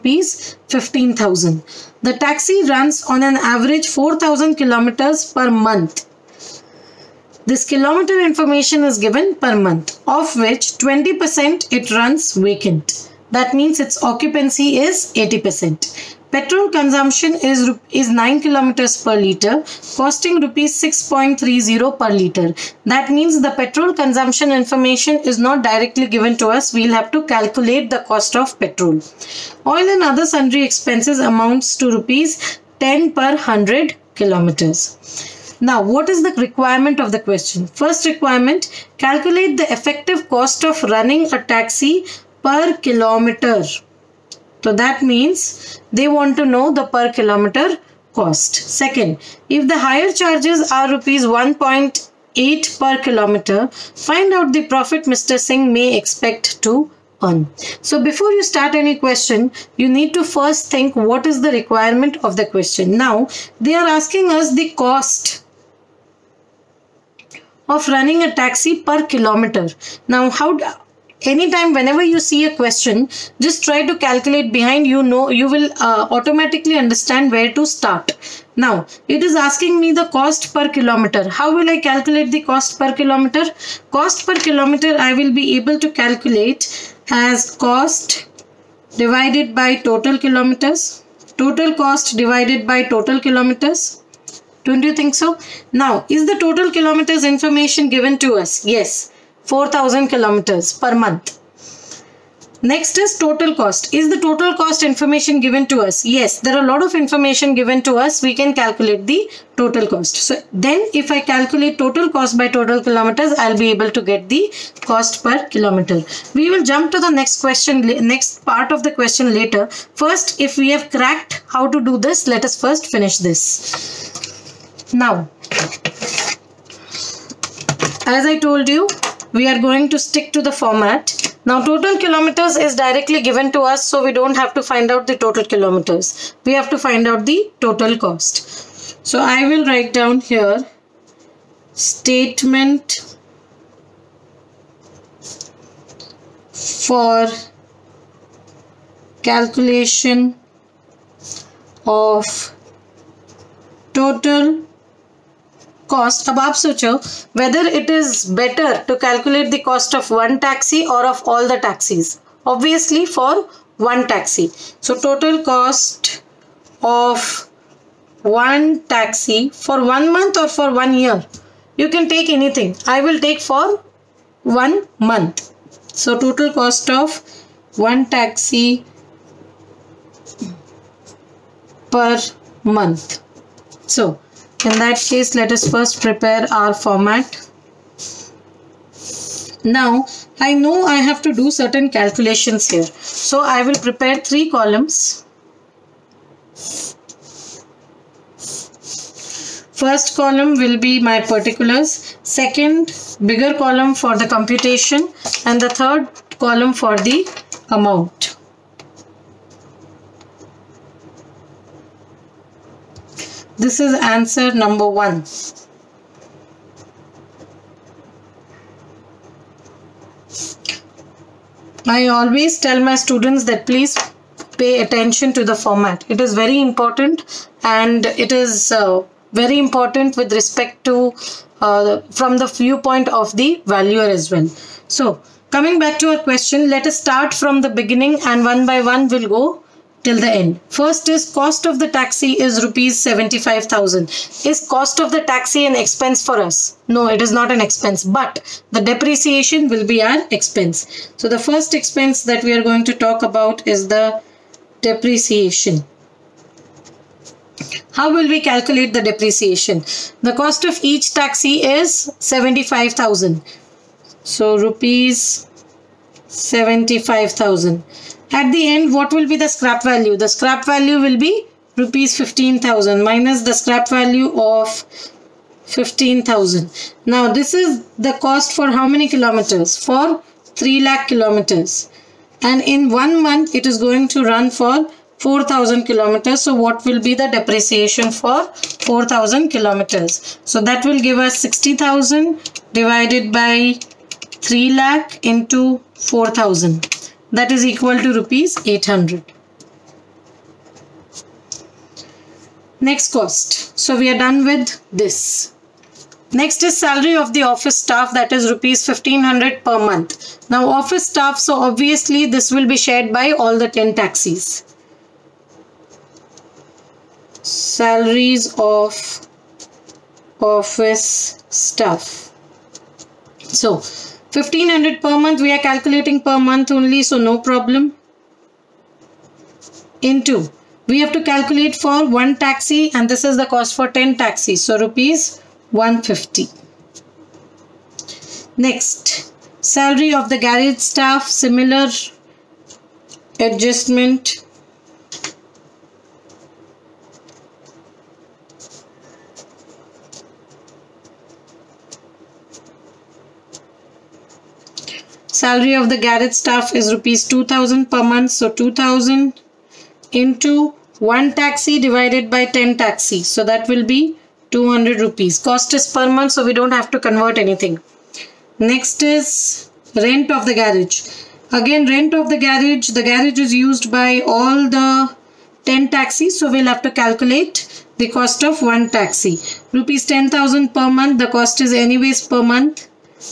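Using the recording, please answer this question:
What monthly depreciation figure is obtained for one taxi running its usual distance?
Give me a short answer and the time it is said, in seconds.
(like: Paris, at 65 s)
Rs 800, at 298 s.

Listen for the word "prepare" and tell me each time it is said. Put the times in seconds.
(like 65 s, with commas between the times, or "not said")
186 s, 193 s.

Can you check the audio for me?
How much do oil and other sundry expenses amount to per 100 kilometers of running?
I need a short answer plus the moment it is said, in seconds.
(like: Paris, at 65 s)
Rs 10, at 31 s.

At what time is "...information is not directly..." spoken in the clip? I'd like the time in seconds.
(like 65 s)
24 s.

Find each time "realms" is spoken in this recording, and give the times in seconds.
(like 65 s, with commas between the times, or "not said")
not said.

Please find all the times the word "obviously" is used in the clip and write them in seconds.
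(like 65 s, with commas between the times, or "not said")
162 s, 311 s.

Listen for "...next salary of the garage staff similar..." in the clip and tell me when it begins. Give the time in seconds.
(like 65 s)
338 s.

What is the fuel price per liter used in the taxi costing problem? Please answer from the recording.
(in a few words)
Rs 6.30.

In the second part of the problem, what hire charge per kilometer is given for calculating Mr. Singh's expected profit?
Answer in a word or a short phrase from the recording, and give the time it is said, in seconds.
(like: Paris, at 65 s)
Rs 1.8, at 50 s.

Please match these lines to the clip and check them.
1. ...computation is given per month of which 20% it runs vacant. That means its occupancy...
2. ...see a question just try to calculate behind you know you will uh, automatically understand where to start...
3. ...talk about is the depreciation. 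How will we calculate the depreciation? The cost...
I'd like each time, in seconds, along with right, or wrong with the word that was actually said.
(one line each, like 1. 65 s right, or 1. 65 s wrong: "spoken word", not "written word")
1. 8 s wrong: "information", not "computation"
2. 72 s right
3. 252 s right.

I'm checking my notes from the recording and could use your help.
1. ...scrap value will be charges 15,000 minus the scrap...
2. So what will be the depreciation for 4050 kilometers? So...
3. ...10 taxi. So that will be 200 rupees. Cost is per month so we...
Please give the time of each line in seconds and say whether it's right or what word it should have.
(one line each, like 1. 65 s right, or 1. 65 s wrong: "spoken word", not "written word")
1. 270 s wrong: "rupees", not "charges"
2. 286 s wrong: "4000", not "4050"
3. 362 s right.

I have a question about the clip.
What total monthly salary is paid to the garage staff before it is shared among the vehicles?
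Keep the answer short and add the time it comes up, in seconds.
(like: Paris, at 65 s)
Rs 2000, at 356 s.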